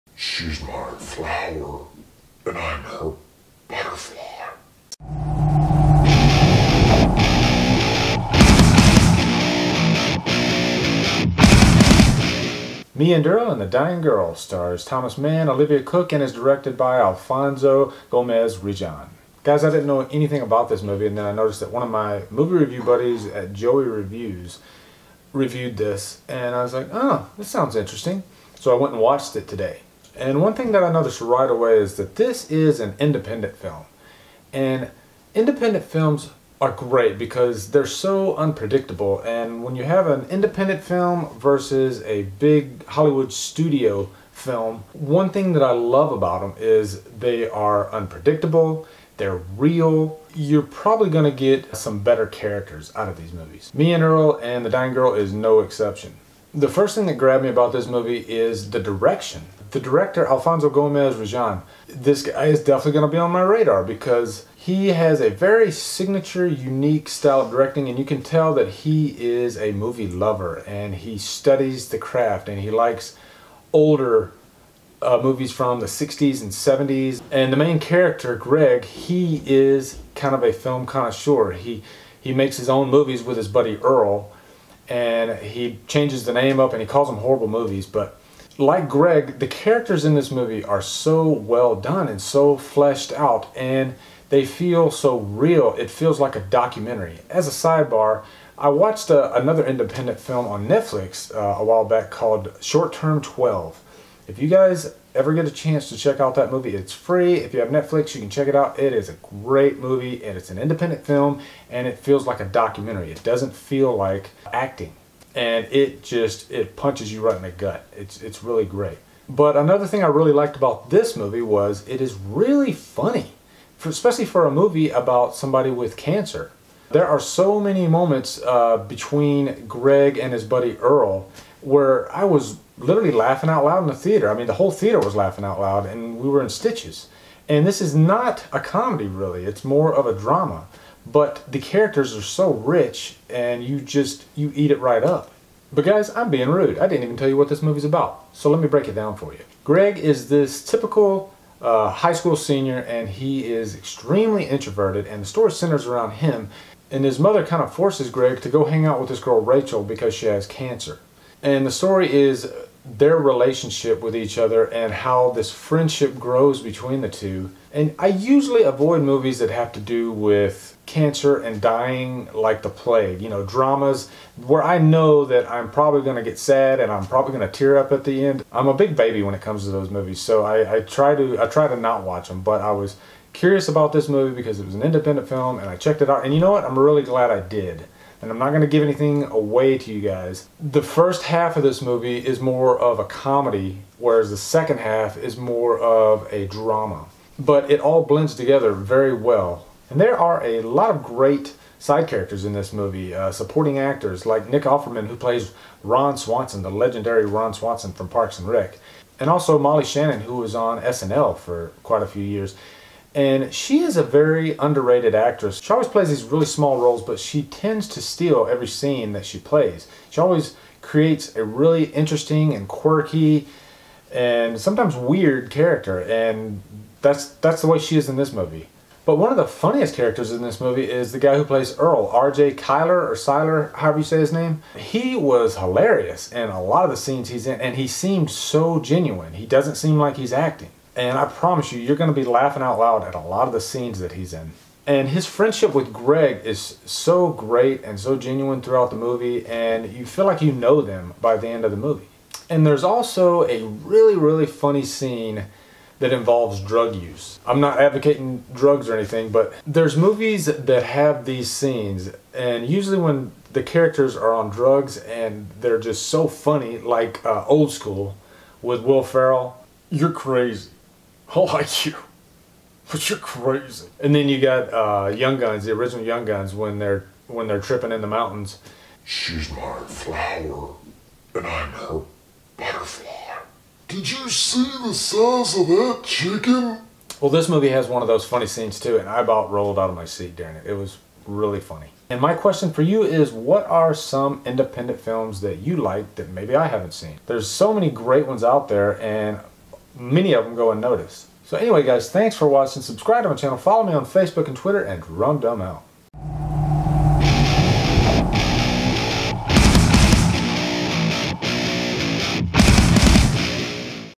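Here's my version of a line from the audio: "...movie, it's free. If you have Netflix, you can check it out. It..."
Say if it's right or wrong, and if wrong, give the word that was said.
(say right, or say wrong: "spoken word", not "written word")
right.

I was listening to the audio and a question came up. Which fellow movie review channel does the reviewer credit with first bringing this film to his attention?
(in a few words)
Joey Reviews.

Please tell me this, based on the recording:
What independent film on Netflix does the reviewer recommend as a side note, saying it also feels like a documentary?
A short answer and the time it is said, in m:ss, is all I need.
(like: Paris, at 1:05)
Short Term 12, at 1:42.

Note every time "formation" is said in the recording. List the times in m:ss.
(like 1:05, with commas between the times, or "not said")
not said.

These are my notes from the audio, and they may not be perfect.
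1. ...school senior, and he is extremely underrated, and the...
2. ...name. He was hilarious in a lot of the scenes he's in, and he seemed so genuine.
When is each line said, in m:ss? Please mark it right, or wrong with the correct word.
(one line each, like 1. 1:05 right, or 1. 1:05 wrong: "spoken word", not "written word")
1. 2:32 wrong: "introverted", not "underrated"
2. 3:54 right.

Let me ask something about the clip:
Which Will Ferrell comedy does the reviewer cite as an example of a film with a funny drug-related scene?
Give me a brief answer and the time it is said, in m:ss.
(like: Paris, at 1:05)
Old School, at 4:27.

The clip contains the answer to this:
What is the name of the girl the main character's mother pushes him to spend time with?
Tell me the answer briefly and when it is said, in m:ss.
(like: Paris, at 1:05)
Rachel, at 2:39.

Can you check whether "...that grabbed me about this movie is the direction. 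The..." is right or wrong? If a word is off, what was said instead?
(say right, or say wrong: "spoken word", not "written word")
right.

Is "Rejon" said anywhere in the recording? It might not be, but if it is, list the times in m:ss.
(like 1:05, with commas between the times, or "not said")
0:18, 1:01.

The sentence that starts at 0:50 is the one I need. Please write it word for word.
You're probably going to get some better characters out of these movies.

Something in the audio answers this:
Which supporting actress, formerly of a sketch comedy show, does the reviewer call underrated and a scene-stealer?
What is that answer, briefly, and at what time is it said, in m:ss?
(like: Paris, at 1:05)
Molly Shannon, at 3:29.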